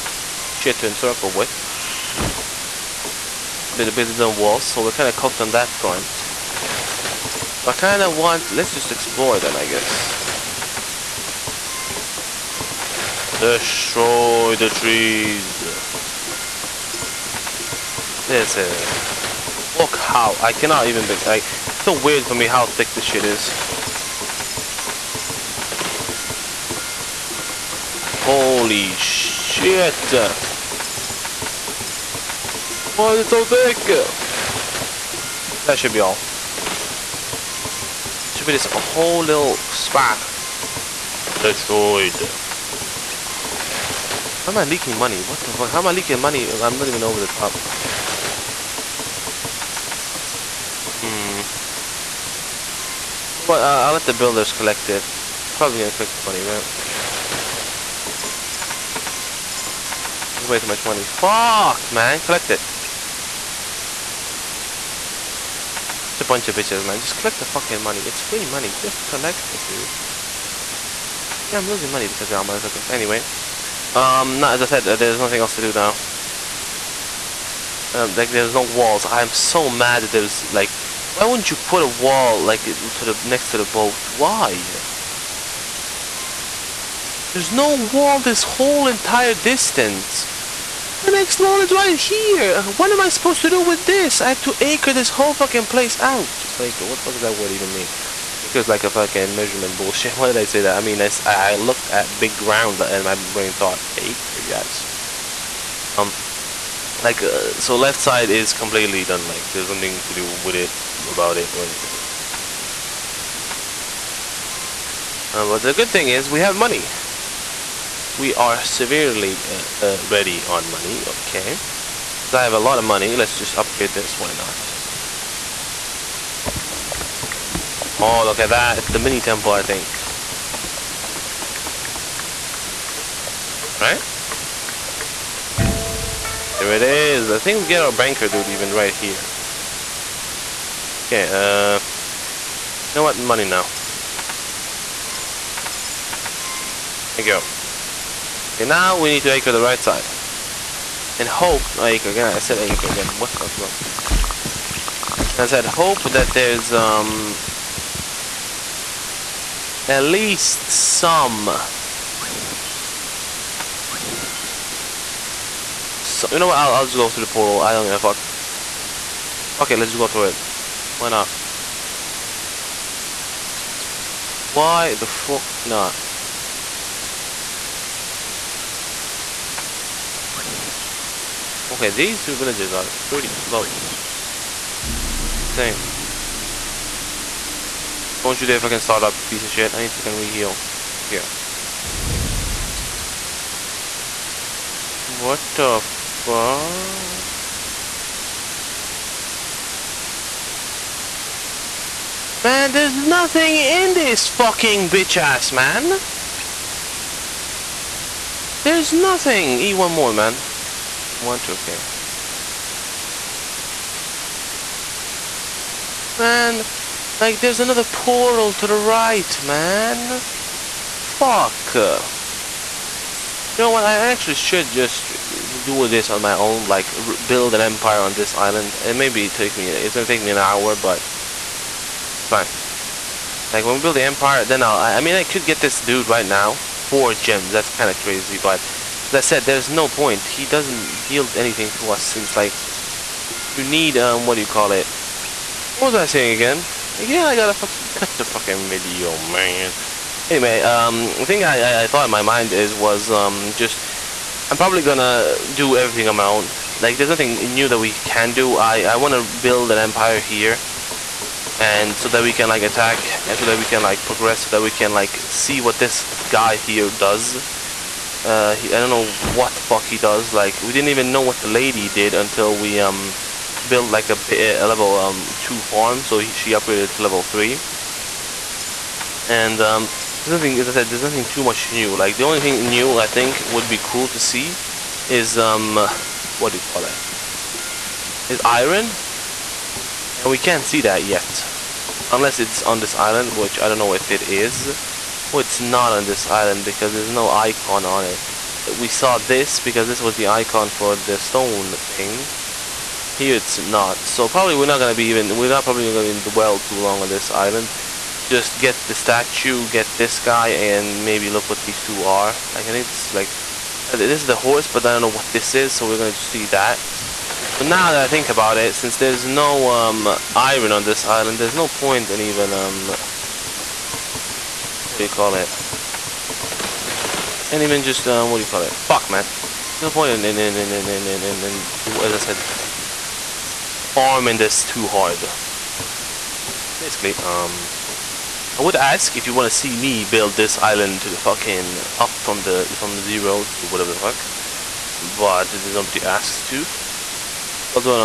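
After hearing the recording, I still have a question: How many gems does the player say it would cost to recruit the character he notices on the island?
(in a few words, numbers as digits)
4.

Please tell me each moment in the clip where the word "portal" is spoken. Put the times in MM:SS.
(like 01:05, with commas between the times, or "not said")
02:47, 03:37.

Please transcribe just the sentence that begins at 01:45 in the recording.
Um, like, uh, so left side is completely done, like, there's nothing to do with it, about it, or anything.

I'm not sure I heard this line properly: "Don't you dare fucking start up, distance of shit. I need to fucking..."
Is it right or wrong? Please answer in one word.
wrong.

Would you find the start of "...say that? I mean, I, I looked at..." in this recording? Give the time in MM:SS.
01:40.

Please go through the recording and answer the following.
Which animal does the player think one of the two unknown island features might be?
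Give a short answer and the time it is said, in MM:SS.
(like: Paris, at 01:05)
Horse, at 05:14.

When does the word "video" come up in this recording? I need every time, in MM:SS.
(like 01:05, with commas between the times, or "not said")
04:08.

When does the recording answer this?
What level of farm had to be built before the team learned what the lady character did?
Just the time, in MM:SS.
04:34.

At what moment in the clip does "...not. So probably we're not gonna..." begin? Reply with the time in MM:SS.
05:03.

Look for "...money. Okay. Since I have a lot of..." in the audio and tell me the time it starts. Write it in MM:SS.
02:00.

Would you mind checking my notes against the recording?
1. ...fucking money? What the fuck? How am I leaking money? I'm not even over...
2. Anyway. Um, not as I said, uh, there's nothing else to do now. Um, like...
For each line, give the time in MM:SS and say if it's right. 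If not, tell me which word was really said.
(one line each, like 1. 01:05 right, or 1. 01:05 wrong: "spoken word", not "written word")
1. 00:44 wrong: "leaking", not "fucking"
2. 01:12 right.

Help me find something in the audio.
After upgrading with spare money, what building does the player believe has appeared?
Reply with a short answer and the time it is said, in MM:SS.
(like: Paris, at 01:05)
Mini temple, at 02:08.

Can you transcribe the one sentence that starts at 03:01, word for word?
Okay, these two villages are pretty close.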